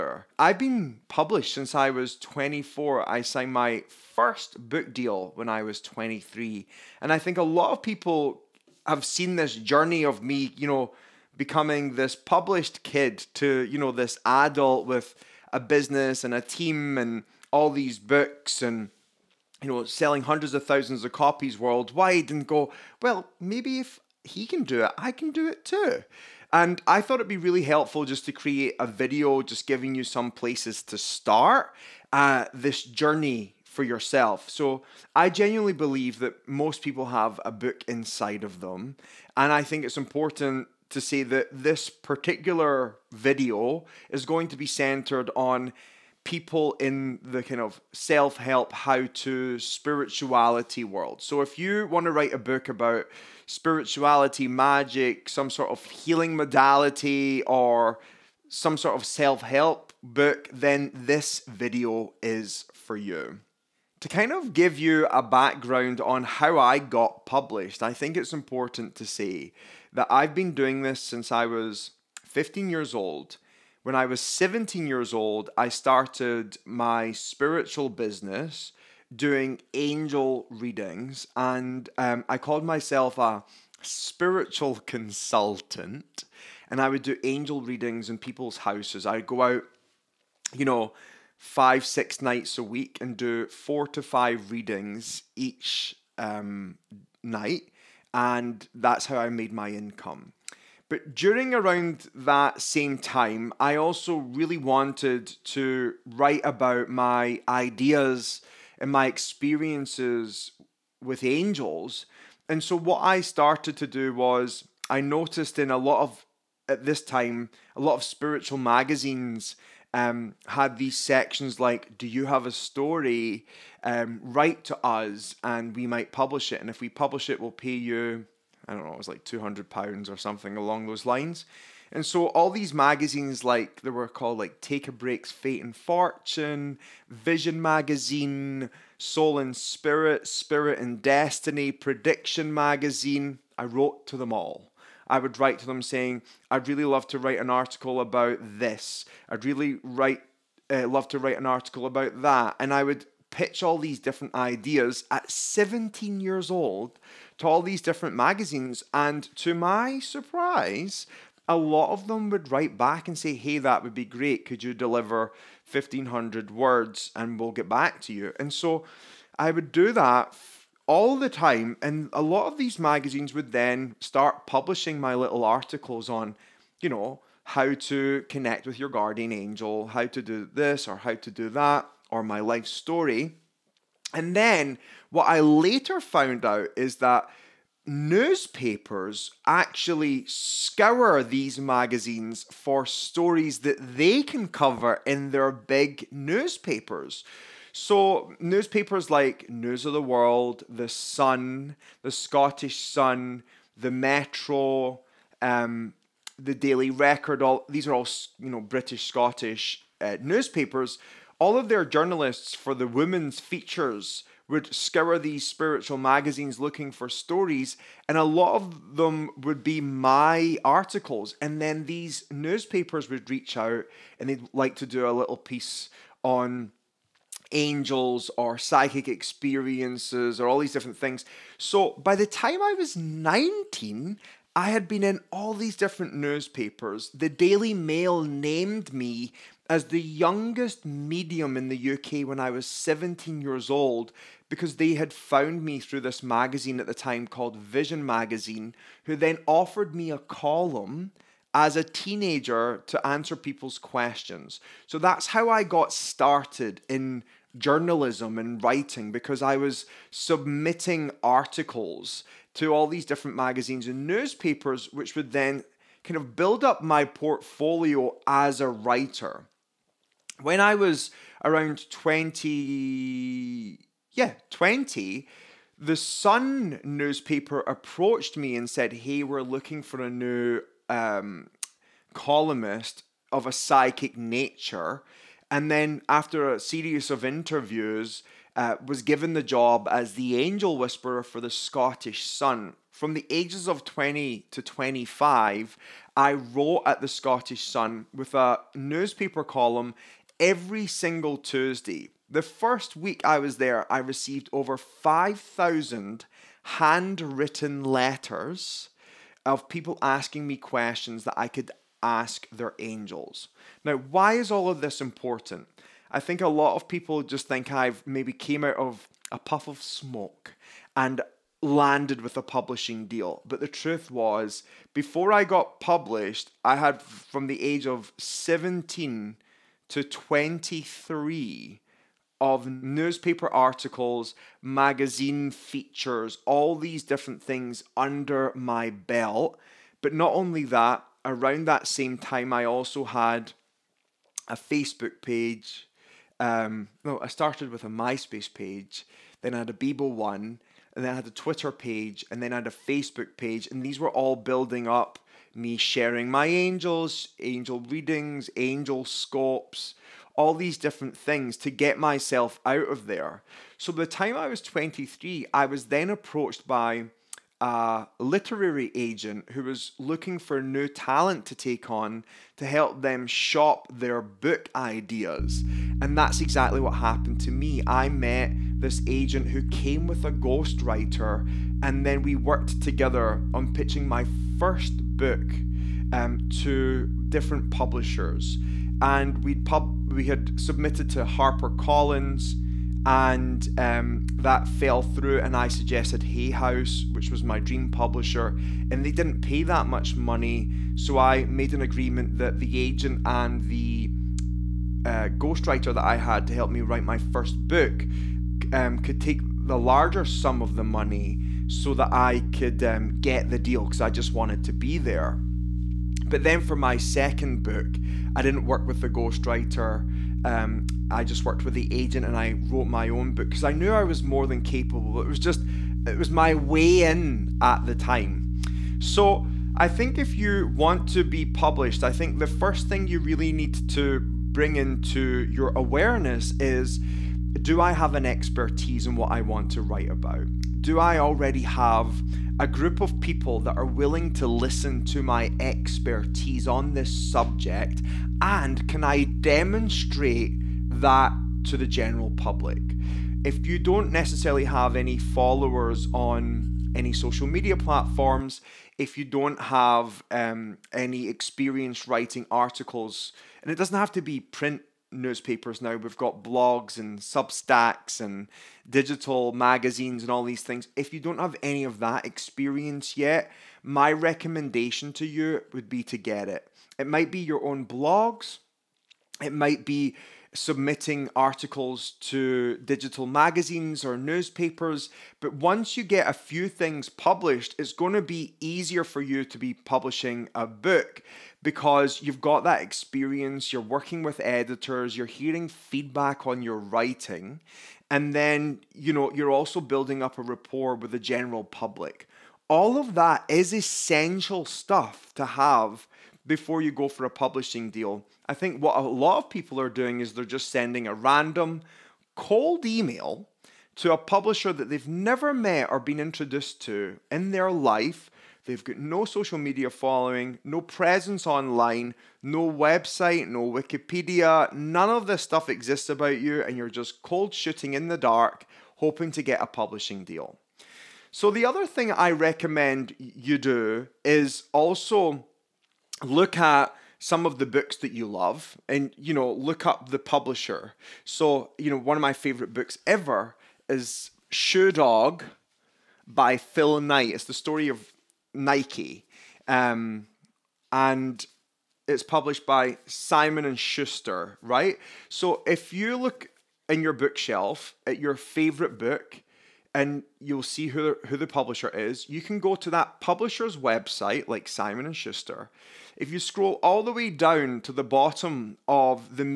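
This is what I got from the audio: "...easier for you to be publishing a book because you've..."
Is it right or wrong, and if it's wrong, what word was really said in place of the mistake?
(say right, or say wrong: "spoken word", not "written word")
right.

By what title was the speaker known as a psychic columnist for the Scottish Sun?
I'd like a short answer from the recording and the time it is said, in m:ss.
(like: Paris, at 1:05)
The angel whisperer, at 4:50.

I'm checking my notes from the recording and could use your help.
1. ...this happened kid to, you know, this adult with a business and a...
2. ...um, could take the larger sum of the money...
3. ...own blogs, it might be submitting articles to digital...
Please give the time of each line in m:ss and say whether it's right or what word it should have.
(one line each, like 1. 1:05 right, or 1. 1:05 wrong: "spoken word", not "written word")
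1. 0:11 wrong: "published", not "happened"
2. 6:48 right
3. 7:57 right.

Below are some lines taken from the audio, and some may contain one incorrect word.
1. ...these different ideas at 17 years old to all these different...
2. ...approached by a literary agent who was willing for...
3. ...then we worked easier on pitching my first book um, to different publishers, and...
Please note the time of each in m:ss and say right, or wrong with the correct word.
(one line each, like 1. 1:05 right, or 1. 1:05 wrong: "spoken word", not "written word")
1. 2:33 right
2. 6:06 wrong: "looking", not "willing"
3. 6:22 wrong: "together", not "easier".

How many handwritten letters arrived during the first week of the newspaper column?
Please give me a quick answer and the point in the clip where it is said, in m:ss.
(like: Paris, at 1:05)
5,000, at 5:04.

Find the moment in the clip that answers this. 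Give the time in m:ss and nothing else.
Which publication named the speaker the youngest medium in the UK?
3:57.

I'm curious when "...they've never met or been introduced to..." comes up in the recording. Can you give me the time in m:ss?
8:34.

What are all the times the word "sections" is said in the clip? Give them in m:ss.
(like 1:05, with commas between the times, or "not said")
2:00.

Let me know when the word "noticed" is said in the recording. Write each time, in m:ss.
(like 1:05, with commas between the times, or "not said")
1:55.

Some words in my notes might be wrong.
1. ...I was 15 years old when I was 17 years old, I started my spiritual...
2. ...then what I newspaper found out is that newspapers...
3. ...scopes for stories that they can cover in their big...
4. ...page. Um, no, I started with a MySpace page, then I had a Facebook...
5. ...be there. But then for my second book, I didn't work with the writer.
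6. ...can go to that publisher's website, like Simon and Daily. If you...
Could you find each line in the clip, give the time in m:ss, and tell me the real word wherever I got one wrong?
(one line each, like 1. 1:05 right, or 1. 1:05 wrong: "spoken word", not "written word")
1. 1:11 right
2. 3:04 wrong: "later", not "newspaper"
3. 3:11 wrong: "magazines", not "scopes"
4. 5:45 wrong: "Bebo", not "Facebook"
5. 6:54 wrong: "ghostwriter", not "writer"
6. 9:22 wrong: "Schuster", not "Daily".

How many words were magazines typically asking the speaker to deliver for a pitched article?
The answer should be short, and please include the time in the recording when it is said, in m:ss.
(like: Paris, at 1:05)
1500, at 2:45.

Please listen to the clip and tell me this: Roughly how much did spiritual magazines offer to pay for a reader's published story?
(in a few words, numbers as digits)
200 pounds.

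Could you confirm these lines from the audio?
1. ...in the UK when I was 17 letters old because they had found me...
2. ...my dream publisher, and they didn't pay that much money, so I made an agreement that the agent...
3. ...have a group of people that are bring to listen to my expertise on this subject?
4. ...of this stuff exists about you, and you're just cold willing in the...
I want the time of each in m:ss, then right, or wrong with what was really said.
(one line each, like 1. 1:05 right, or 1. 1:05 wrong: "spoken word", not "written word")
1. 4:01 wrong: "years", not "letters"
2. 6:37 right
3. 7:21 wrong: "willing", not "bring"
4. 8:45 wrong: "shooting", not "willing".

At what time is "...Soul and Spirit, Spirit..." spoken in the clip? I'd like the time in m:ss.
2:18.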